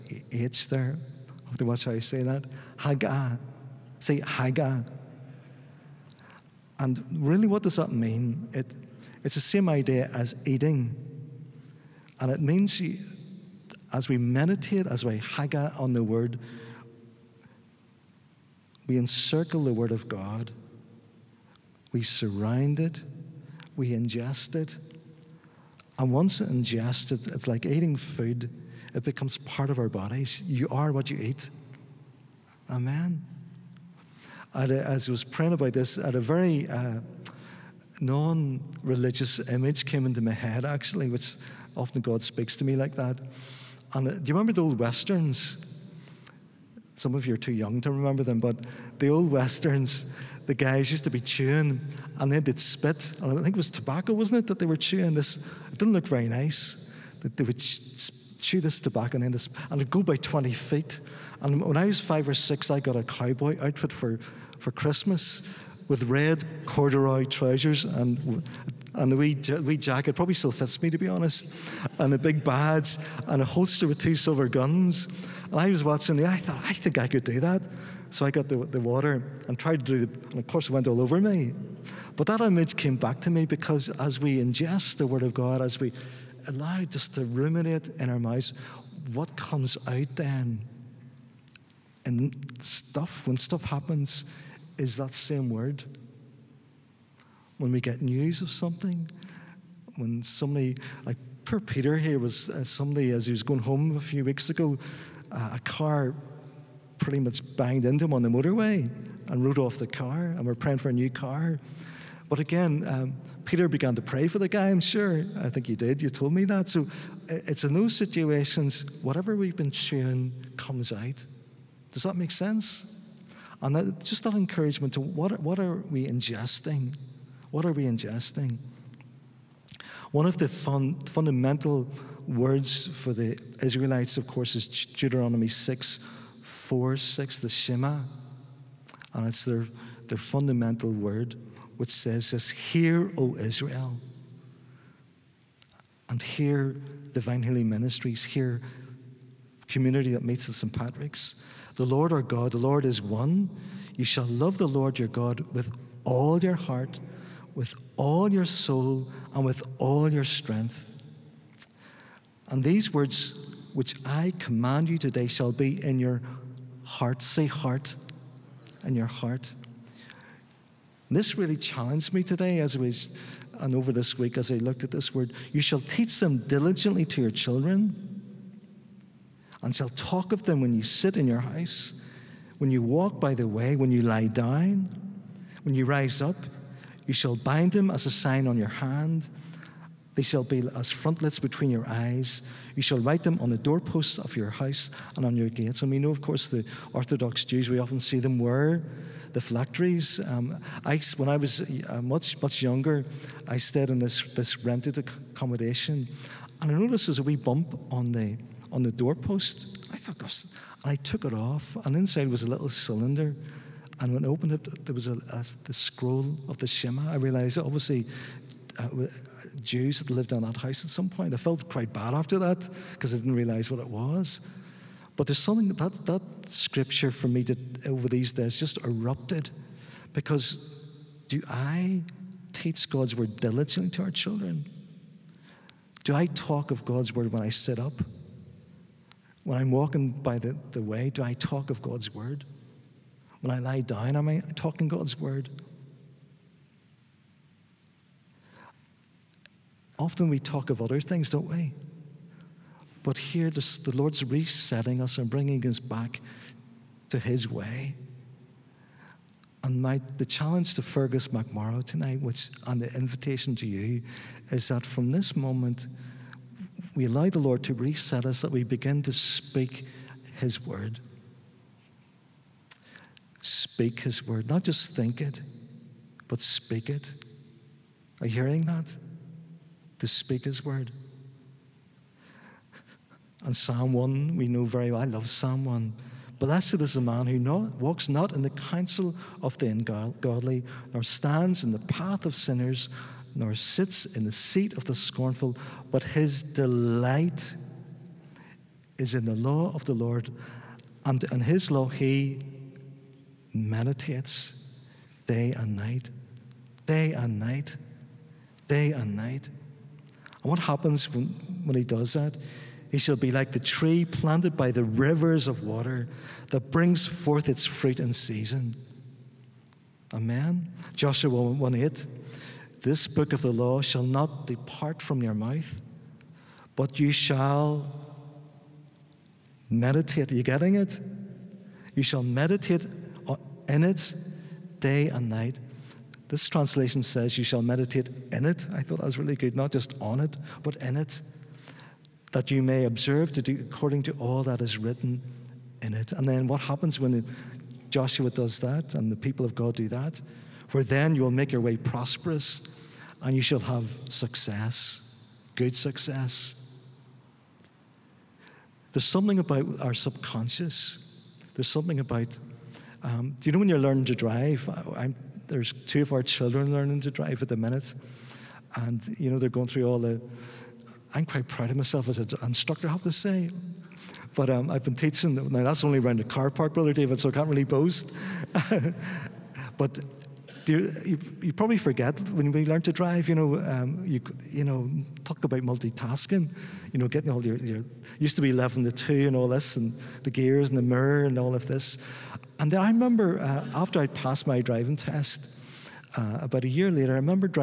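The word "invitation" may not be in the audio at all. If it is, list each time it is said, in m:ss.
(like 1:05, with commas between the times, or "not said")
4:22.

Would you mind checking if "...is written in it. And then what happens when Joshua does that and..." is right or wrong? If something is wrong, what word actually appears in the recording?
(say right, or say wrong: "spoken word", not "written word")
right.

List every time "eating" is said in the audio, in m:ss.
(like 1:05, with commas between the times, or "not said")
0:10, 0:27.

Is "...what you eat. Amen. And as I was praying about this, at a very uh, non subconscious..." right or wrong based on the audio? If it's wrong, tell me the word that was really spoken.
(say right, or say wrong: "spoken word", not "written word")
wrong: "religious", not "subconscious".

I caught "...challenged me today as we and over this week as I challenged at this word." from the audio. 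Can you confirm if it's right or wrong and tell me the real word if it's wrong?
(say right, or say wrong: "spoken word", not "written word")
wrong: "looked", not "challenged".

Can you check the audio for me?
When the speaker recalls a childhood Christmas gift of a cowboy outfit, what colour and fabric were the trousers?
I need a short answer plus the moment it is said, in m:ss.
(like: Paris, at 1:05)
red corduroy, at 1:06.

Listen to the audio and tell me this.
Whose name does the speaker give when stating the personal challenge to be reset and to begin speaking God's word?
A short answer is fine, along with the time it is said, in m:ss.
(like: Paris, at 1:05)
Fergus McMorrow, at 4:20.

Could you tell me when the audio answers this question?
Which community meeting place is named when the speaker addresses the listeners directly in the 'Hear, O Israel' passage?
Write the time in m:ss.
2:30.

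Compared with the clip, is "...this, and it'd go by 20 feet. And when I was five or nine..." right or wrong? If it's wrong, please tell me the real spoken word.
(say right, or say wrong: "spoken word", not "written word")
wrong: "six", not "nine".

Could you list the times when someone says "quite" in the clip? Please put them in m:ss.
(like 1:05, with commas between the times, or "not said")
3:41, 6:11.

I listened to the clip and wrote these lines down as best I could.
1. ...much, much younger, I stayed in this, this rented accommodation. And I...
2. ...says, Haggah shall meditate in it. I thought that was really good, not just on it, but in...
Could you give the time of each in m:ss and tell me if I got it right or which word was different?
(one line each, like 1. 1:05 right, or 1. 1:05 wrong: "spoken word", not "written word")
1. 3:22 right
2. 5:37 wrong: "You", not "Haggah".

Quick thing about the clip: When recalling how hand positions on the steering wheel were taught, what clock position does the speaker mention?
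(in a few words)
11 to 2.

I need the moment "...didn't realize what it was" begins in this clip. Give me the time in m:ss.
3:43.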